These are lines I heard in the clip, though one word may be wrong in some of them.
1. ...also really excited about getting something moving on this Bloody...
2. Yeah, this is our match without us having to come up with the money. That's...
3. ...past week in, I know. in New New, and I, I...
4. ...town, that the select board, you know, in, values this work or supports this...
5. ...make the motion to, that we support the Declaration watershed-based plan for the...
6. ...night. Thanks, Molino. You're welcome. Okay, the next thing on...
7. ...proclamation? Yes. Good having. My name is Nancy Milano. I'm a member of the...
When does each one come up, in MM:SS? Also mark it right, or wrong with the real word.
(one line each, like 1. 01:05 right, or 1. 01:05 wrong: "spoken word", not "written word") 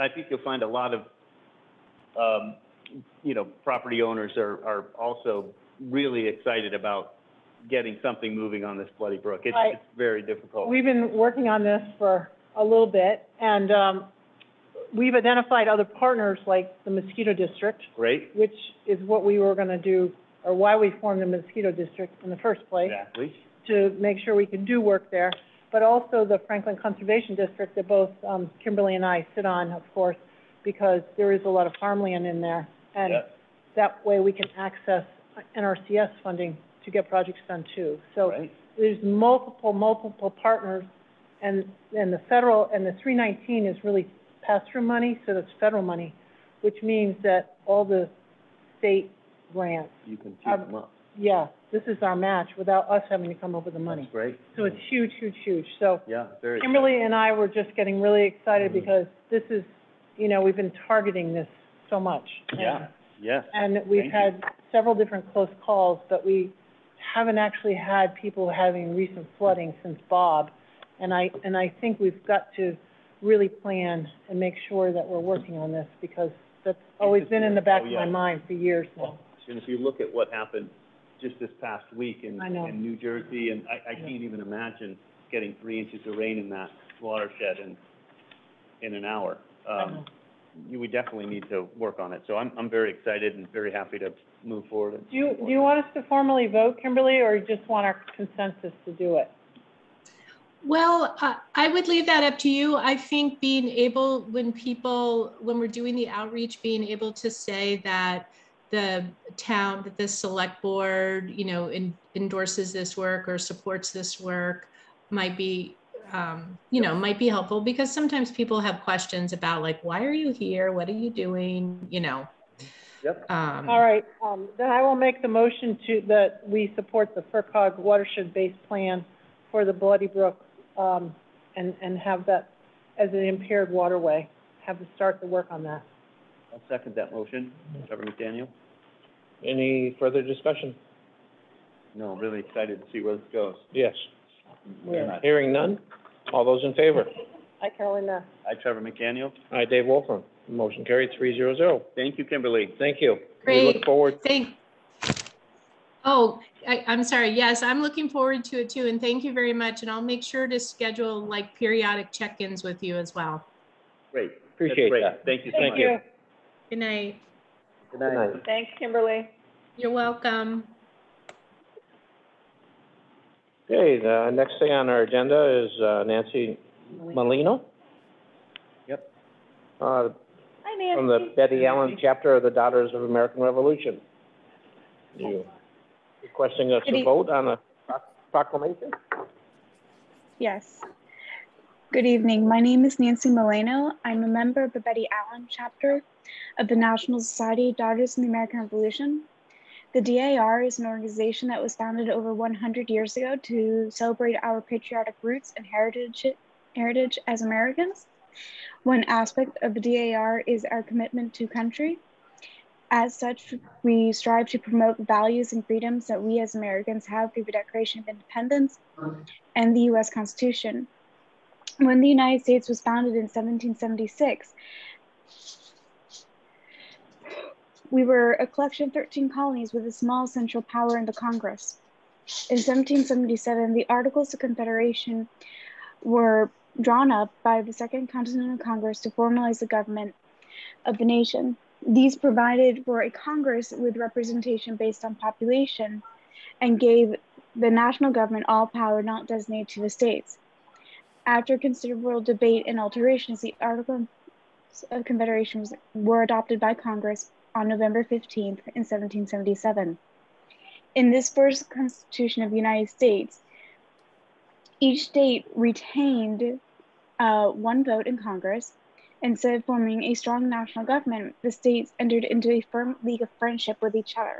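1. 00:04 right
2. 00:51 right
3. 01:21 wrong: "Jersey", not "New"
4. 01:49 wrong: "endorses", not "values"
5. 02:04 wrong: "FRCOG", not "Declaration"
6. 02:47 wrong: "Kimberly", not "Molino"
7. 03:08 wrong: "evening", not "having".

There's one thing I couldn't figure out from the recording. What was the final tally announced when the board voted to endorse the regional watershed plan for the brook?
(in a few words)
3-0-0.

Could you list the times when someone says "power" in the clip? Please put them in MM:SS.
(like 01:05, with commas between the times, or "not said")
03:50, 04:08.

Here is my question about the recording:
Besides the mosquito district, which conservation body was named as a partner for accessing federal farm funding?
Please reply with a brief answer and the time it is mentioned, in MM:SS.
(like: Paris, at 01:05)
Franklin Conservation District, at 00:26.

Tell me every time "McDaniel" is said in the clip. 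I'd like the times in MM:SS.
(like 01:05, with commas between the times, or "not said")
02:18, 02:28.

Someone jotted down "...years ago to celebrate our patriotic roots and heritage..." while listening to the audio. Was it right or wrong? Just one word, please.
right.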